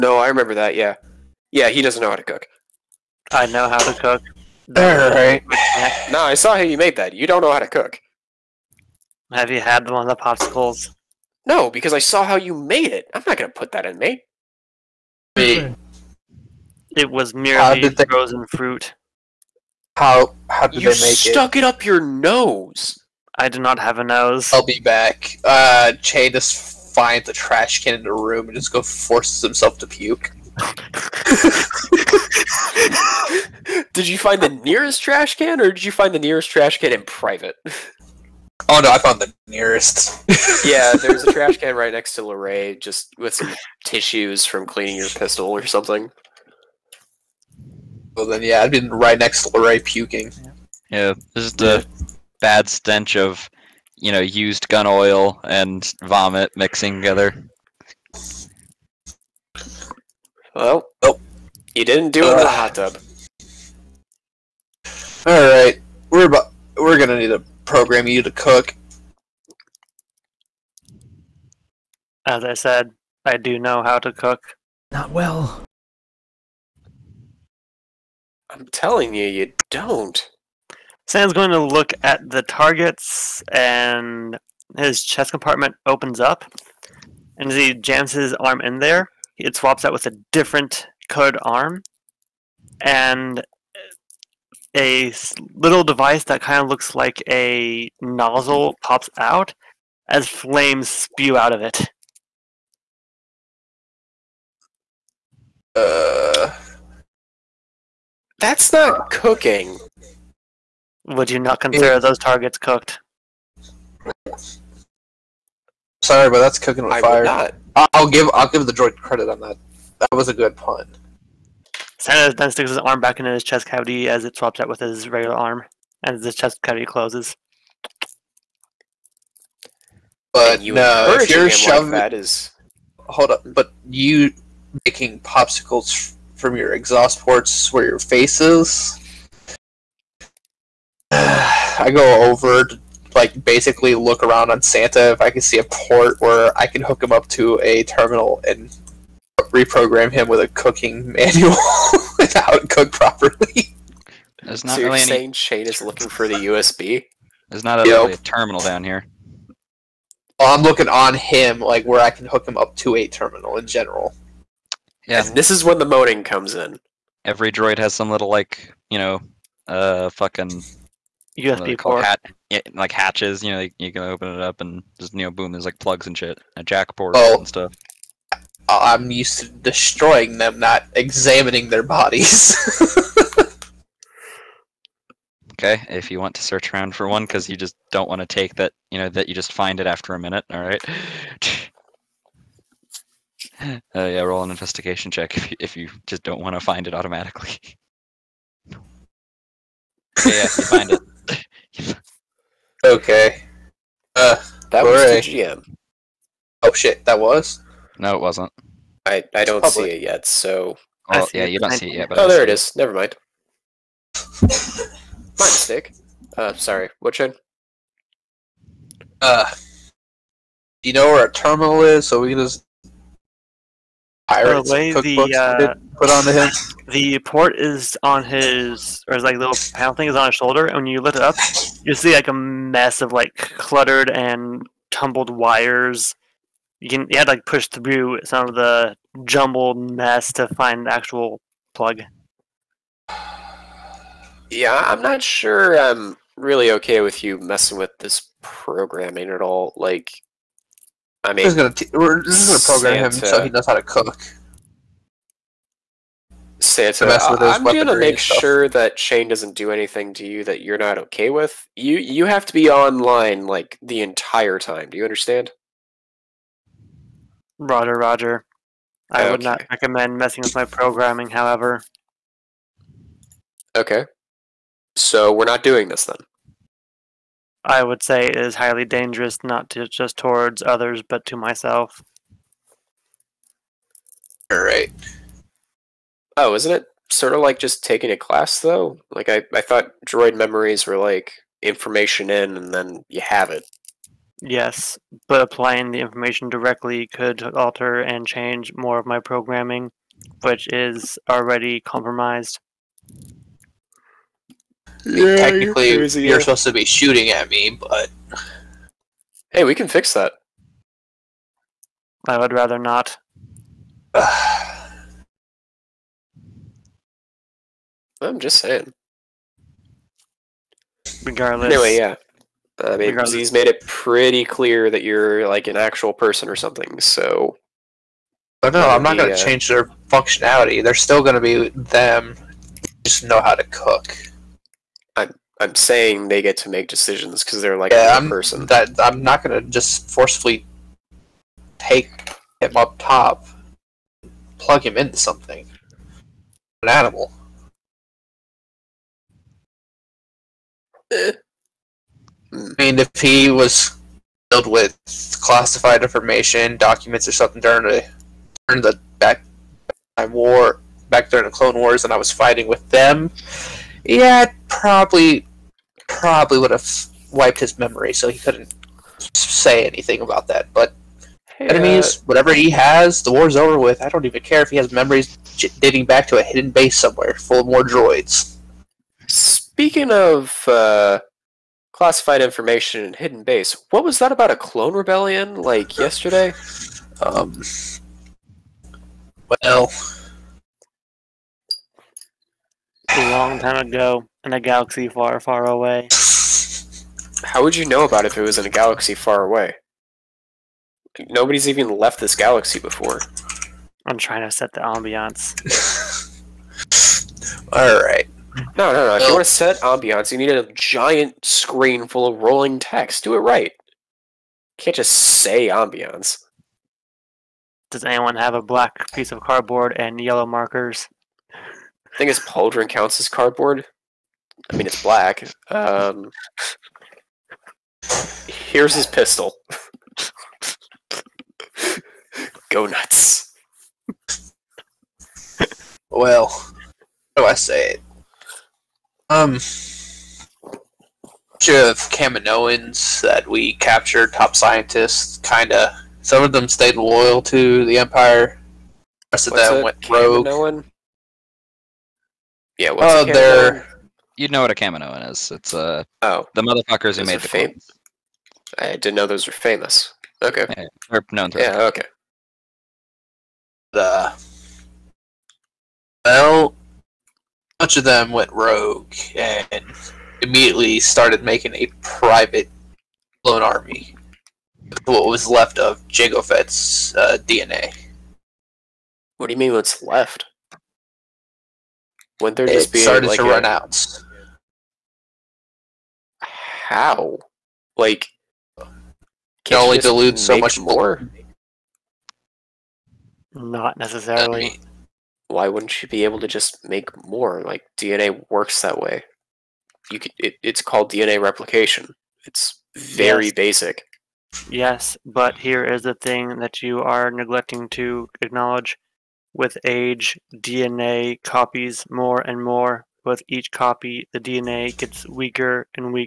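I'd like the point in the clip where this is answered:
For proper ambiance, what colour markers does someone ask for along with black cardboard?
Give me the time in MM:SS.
07:00.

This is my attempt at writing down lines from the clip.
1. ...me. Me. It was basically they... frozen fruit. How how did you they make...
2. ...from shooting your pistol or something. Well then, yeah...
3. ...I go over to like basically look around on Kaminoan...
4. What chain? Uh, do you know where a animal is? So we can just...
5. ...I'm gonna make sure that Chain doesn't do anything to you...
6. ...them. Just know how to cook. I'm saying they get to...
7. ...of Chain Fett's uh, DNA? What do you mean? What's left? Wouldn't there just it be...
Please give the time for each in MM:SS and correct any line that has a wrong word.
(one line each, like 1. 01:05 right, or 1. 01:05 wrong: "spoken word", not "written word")
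1. 00:13 wrong: "merely", not "basically"
2. 00:44 wrong: "cleaning", not "shooting"
3. 02:21 wrong: "Santa", not "Kaminoan"
4. 03:37 wrong: "terminal", not "animal"
5. 04:17 right
6. 05:31 right
7. 07:55 wrong: "Jango", not "Chain".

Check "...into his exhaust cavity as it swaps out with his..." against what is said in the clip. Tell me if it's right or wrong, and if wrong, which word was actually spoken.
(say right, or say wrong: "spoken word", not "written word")
wrong: "chest", not "exhaust".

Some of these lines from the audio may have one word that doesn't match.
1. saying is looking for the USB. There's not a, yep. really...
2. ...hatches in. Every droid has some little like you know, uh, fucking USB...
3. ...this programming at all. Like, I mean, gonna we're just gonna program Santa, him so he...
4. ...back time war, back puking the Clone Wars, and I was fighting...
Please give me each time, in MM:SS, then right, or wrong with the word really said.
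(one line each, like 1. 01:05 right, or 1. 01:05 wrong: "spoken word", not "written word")
1. 02:35 right
2. 02:46 wrong: "comes", not "hatches"
3. 04:07 right
4. 05:59 wrong: "during", not "puking".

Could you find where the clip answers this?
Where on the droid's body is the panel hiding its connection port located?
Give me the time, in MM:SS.
03:50.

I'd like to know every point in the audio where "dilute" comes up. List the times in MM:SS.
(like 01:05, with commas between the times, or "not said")
08:09.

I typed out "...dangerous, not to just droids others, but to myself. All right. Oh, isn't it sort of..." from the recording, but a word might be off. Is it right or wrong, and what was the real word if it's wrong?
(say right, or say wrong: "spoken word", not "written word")
wrong: "towards", not "droids".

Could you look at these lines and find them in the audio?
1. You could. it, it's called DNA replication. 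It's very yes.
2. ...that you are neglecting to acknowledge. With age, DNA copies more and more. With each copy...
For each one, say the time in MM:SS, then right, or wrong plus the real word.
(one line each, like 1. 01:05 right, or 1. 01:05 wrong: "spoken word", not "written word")
1. 08:20 right
2. 08:26 right.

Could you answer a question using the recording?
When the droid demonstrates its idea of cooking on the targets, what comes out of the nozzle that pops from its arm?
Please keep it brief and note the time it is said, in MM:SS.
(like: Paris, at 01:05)
Flames, at 01:40.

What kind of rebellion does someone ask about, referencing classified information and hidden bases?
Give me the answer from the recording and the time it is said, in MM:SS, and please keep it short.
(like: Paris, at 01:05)
A clone rebellion, at 06:24.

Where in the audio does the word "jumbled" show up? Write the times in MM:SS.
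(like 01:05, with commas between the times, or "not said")
03:59.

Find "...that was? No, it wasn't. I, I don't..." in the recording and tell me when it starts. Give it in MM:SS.
03:27.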